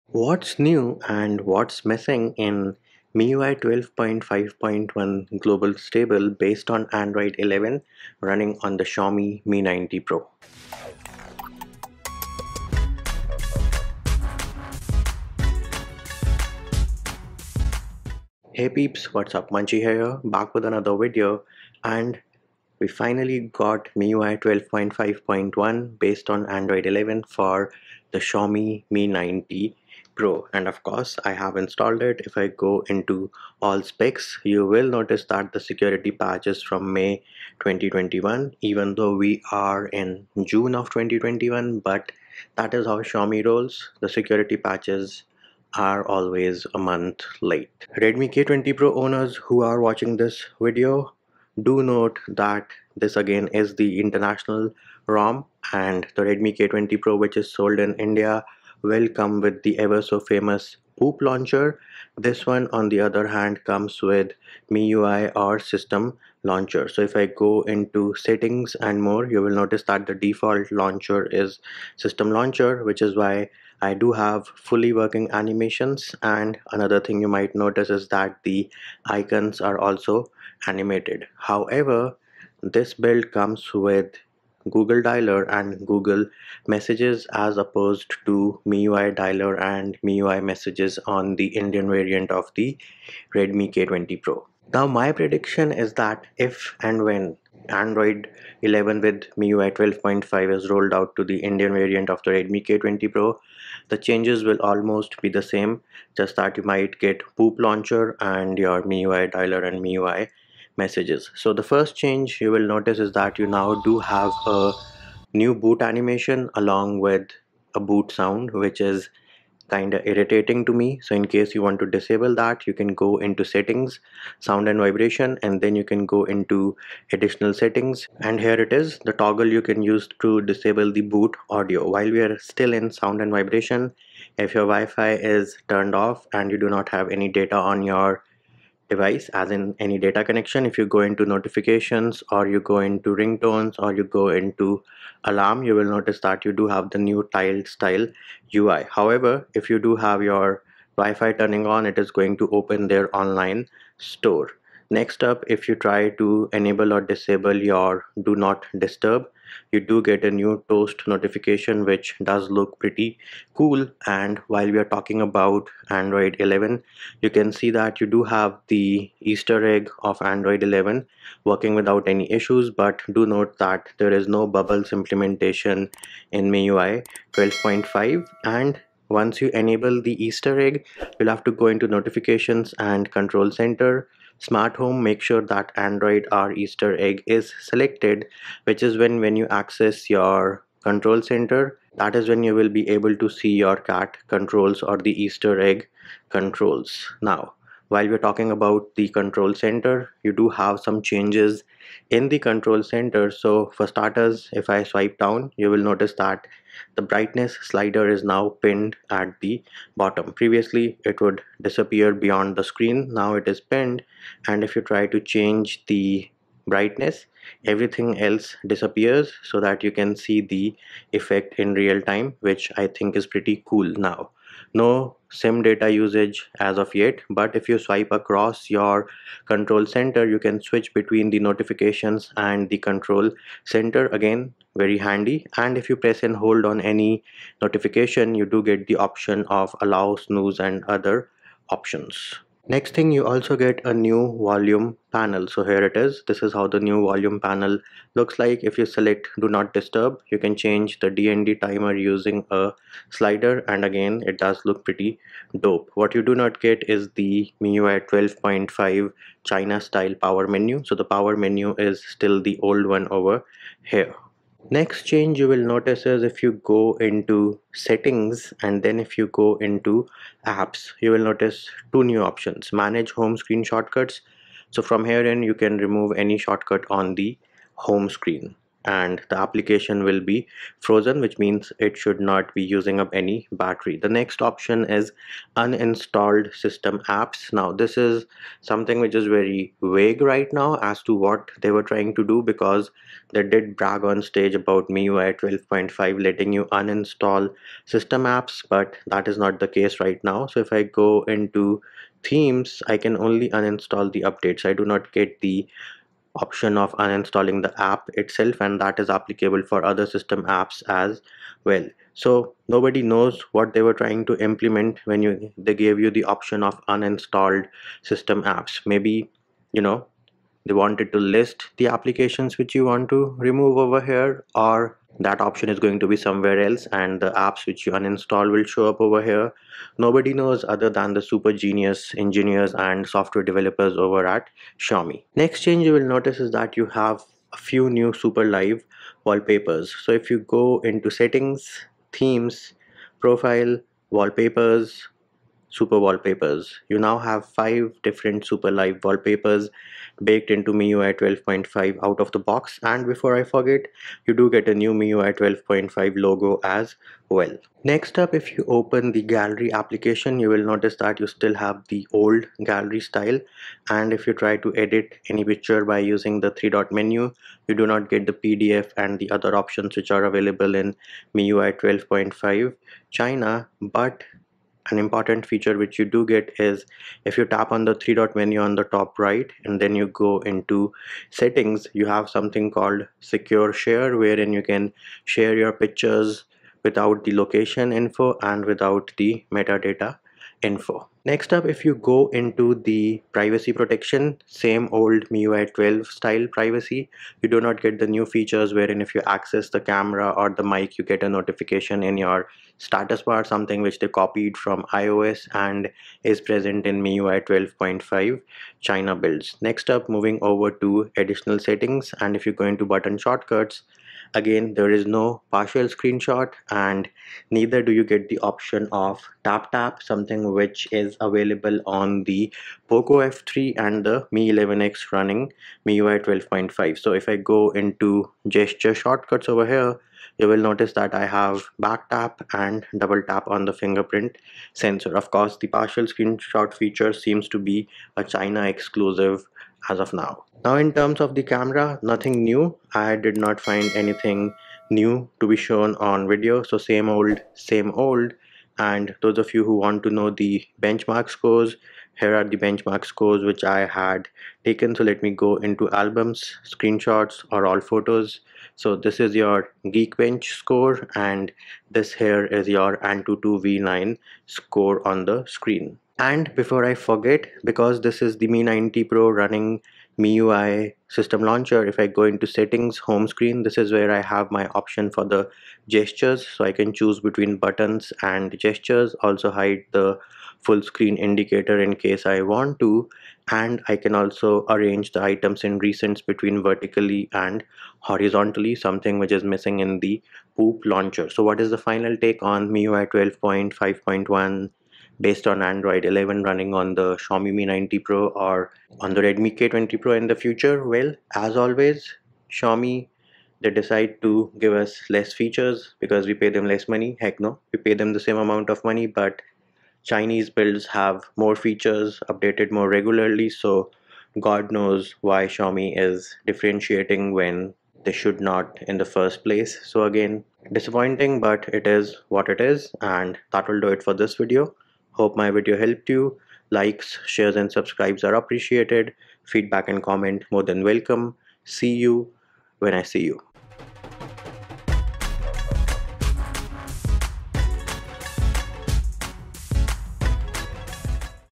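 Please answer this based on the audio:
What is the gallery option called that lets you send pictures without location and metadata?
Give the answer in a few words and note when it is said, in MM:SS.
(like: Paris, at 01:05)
secure share, at 06:23.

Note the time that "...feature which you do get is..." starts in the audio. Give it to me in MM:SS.
06:15.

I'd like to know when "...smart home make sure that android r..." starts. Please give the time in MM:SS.
03:04.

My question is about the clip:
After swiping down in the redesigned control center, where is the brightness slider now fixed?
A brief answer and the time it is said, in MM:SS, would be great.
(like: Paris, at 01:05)
at the bottom, at 03:29.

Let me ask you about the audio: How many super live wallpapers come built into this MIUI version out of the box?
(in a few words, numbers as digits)
5.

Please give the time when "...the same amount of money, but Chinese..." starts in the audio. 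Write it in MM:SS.
08:28.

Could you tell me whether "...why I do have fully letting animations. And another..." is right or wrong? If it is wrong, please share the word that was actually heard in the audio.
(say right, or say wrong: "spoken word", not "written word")
wrong: "working", not "letting".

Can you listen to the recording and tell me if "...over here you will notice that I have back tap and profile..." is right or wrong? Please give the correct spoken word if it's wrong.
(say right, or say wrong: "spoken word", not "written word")
wrong: "double", not "profile".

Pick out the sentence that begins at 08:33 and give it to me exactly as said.
So God knows why Xiaomi is differentiating when they should not in the first place.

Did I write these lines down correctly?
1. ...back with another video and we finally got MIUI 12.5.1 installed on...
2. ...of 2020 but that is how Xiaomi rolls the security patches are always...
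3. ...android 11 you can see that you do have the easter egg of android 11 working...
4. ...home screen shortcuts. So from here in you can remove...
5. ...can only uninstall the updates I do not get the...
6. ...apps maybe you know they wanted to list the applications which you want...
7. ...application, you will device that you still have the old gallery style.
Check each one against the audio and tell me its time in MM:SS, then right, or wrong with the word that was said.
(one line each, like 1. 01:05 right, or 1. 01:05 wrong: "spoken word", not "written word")
1. 00:20 wrong: "based", not "installed"
2. 00:40 wrong: "2021", not "2020"
3. 02:45 right
4. 04:33 right
5. 05:02 right
6. 05:18 right
7. 05:59 wrong: "notice", not "device".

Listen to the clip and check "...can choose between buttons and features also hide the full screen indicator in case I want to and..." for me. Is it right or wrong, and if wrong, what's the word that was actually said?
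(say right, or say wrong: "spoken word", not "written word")
wrong: "gestures", not "features".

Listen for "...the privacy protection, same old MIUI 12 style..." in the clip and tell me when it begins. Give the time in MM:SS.
06:32.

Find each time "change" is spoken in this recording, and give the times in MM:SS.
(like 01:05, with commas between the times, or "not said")
01:43, 01:52, 03:21, 03:35, 04:10, 04:25, 05:35.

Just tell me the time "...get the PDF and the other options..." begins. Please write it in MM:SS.
06:08.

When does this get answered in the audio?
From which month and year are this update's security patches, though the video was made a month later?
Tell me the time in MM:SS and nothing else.
00:36.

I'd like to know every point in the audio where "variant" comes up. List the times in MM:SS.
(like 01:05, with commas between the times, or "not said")
01:31, 01:41.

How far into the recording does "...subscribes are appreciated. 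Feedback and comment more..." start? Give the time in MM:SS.
08:47.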